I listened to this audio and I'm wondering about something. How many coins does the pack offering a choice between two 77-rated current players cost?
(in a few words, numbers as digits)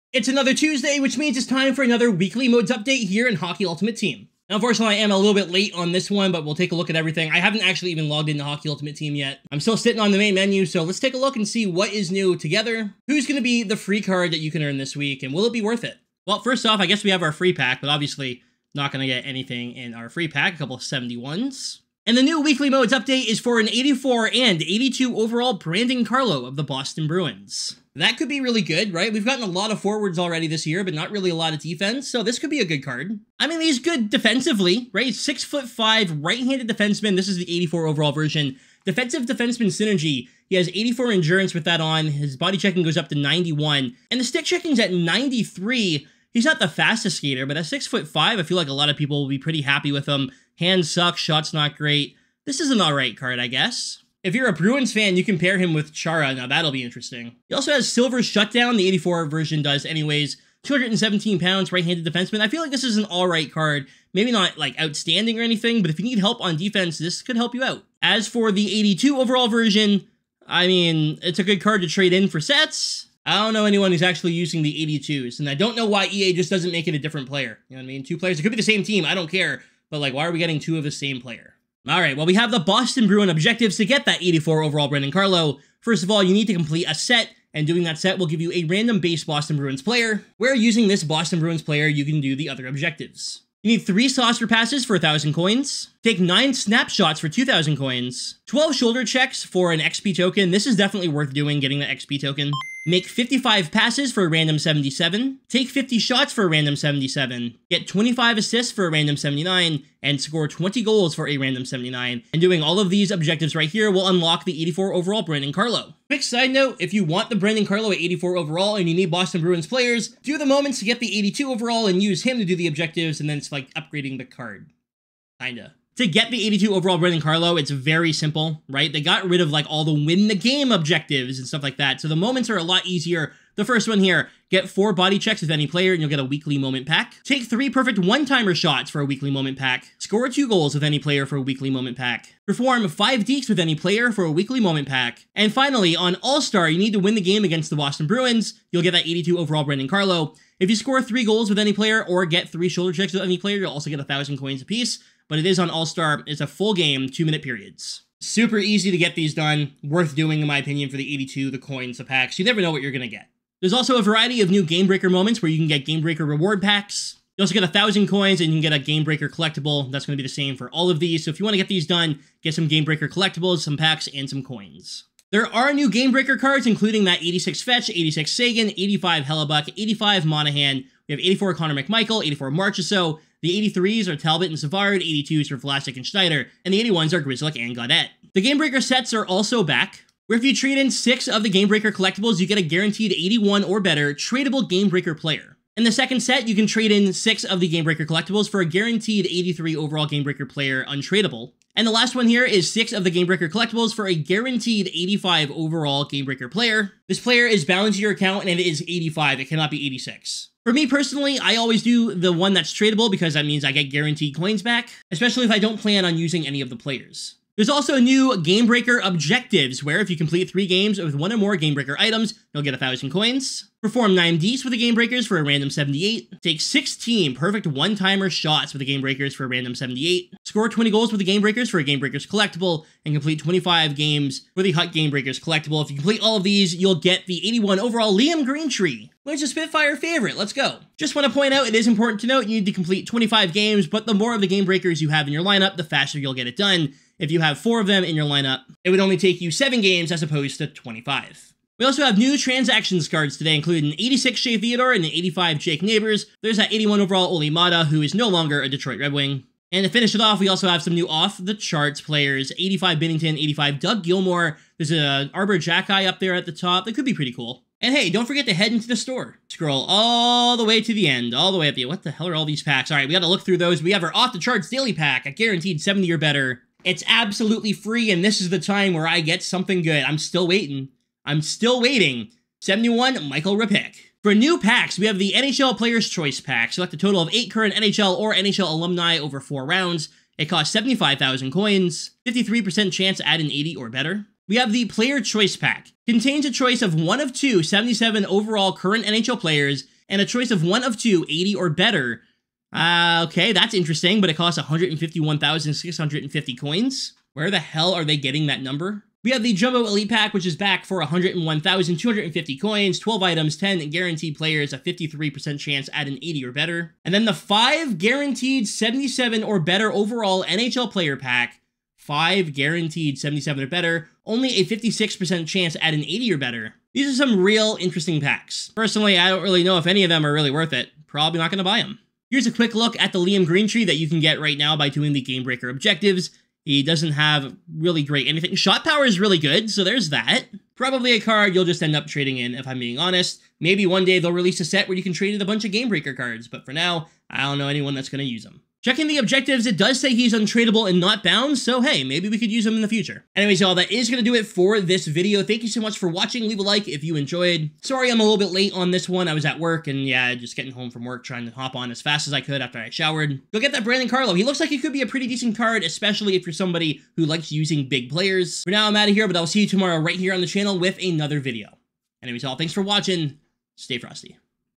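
151,650.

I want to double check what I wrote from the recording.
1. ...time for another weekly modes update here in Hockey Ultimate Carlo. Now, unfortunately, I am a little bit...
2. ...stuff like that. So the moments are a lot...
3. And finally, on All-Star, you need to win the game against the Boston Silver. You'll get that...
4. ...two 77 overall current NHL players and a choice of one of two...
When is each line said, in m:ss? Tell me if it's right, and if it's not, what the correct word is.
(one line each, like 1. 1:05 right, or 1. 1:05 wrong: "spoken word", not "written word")
1. 0:01 wrong: "Team", not "Carlo"
2. 2:11 right
3. 2:25 wrong: "Bruins", not "Silver"
4. 4:57 right.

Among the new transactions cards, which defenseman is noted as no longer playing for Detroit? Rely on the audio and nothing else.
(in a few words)
Olli Maatta.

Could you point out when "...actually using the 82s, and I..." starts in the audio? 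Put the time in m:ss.
1:14.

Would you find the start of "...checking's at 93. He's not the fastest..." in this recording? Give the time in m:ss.
0:44.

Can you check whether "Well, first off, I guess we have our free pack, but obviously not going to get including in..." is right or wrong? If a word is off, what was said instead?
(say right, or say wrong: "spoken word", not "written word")
wrong: "anything", not "including".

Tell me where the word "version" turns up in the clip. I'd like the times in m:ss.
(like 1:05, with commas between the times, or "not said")
0:38, 0:59, 1:09.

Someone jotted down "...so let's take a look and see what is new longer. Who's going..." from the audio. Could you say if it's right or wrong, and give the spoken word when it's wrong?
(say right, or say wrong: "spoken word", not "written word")
wrong: "together", not "longer".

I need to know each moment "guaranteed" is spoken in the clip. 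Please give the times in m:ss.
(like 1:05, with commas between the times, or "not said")
3:12, 3:18, 3:24, 3:33, 4:35, 5:13, 5:17, 5:22.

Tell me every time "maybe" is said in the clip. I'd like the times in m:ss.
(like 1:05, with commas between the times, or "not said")
1:04, 5:43, 5:52.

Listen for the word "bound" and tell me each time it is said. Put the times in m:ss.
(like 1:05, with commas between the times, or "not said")
3:27, 5:51.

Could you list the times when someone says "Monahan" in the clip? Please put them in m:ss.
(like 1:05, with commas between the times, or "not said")
3:00.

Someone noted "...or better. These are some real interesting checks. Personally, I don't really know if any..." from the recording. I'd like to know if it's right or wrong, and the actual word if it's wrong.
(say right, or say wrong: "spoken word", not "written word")
wrong: "packs", not "checks".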